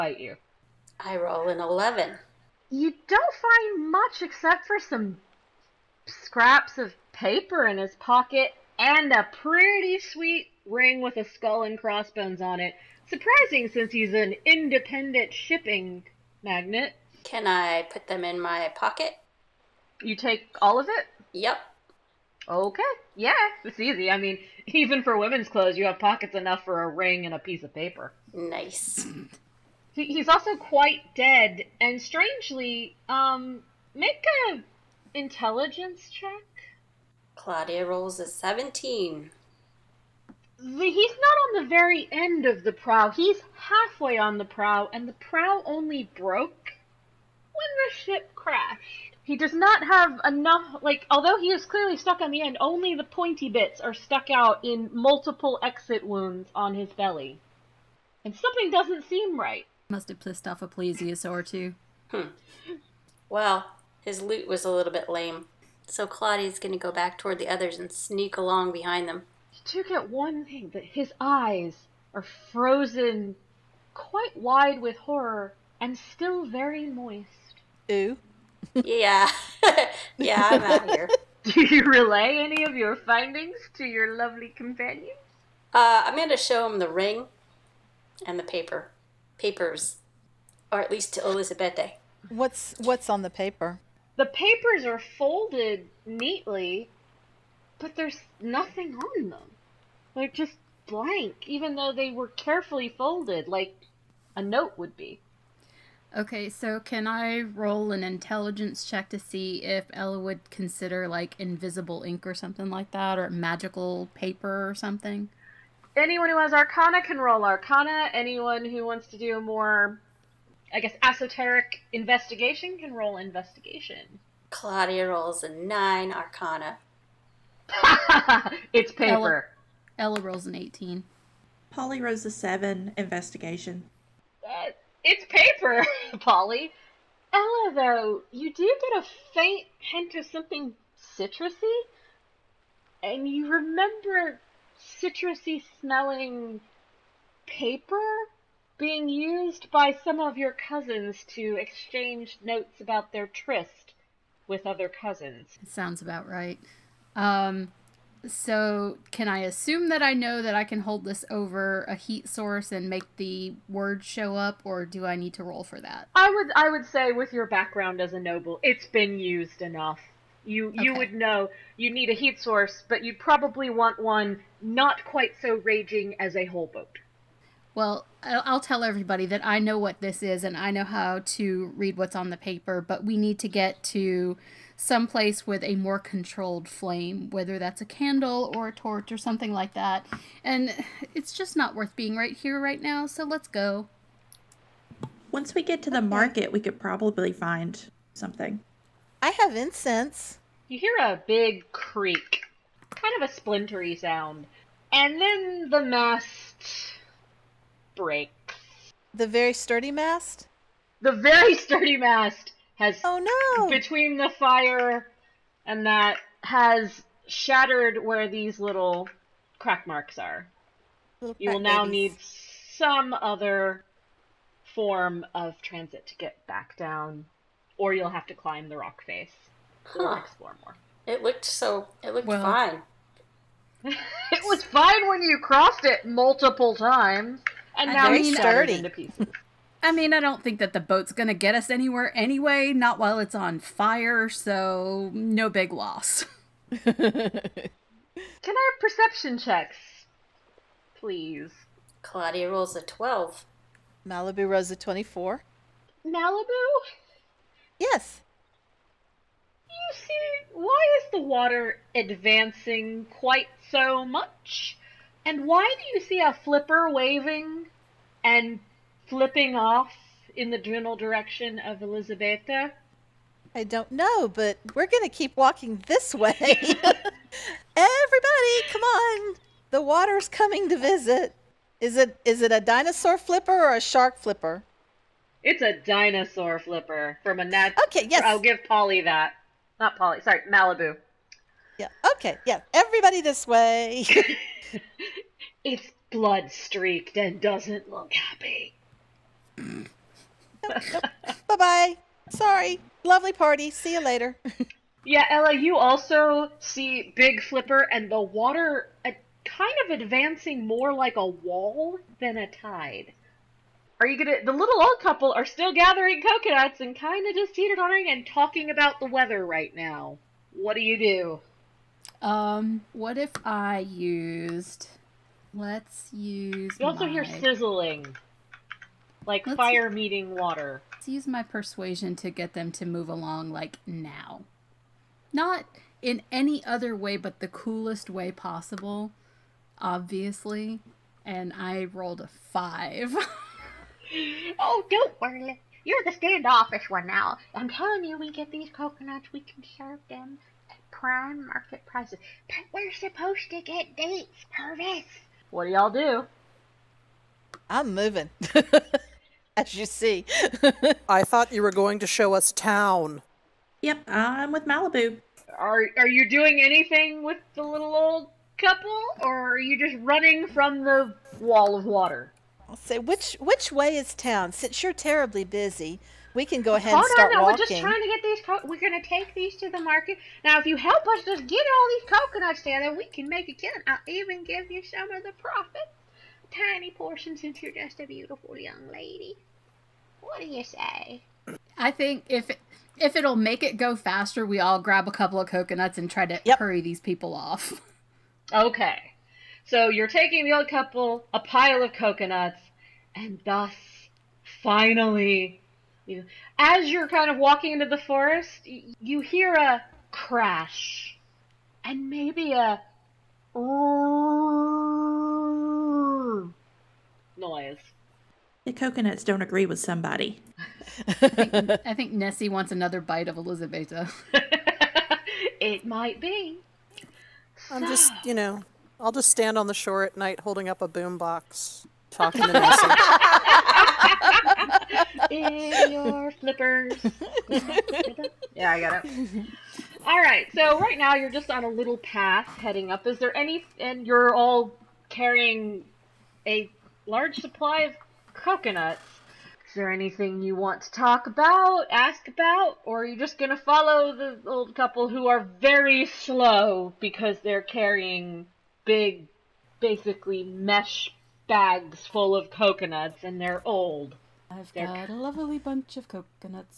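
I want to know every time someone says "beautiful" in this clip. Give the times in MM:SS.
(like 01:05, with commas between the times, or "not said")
06:28.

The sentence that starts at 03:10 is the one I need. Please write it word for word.
And it's just not worth being right here right now, so let's go.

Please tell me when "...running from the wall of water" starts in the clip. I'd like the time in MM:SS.
06:10.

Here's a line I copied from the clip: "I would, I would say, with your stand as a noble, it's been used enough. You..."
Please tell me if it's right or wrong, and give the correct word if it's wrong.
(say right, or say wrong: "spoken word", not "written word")
wrong: "background", not "stand".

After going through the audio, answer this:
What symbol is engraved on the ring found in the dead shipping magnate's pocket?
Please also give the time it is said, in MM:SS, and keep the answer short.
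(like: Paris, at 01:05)
Skull and crossbones, at 00:11.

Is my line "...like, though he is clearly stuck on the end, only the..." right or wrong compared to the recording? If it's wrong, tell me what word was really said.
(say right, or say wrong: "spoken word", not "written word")
wrong: "although", not "though".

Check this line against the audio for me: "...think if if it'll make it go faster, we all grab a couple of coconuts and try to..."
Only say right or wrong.
right.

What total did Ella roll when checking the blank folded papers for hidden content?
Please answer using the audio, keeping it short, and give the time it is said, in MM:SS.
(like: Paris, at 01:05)
18, at 02:10.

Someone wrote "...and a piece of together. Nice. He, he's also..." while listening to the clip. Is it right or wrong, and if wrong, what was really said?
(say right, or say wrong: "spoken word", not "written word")
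wrong: "paper", not "together".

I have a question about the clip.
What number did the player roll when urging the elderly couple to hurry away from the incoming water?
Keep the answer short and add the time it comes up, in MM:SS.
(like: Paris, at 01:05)
5, at 05:42.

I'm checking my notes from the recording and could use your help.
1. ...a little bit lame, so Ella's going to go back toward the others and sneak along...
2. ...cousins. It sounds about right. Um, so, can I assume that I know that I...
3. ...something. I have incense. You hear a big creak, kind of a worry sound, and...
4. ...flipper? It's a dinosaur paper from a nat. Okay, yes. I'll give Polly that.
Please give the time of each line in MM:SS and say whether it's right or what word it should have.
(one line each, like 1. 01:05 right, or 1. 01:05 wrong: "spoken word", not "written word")
1. 01:04 wrong: "Claudia", not "Ella"
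2. 02:34 right
3. 03:18 wrong: "splintery", not "worry"
4. 04:44 wrong: "flipper", not "paper".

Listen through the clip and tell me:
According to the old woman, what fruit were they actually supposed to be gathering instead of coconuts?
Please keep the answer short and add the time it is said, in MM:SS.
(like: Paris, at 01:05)
Dates, at 05:53.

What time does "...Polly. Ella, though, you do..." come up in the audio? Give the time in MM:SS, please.
02:16.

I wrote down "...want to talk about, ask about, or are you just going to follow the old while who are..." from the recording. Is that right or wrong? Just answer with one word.
wrong.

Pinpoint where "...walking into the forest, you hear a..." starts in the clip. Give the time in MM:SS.
06:47.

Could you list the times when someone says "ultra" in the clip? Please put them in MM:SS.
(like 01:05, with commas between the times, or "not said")
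not said.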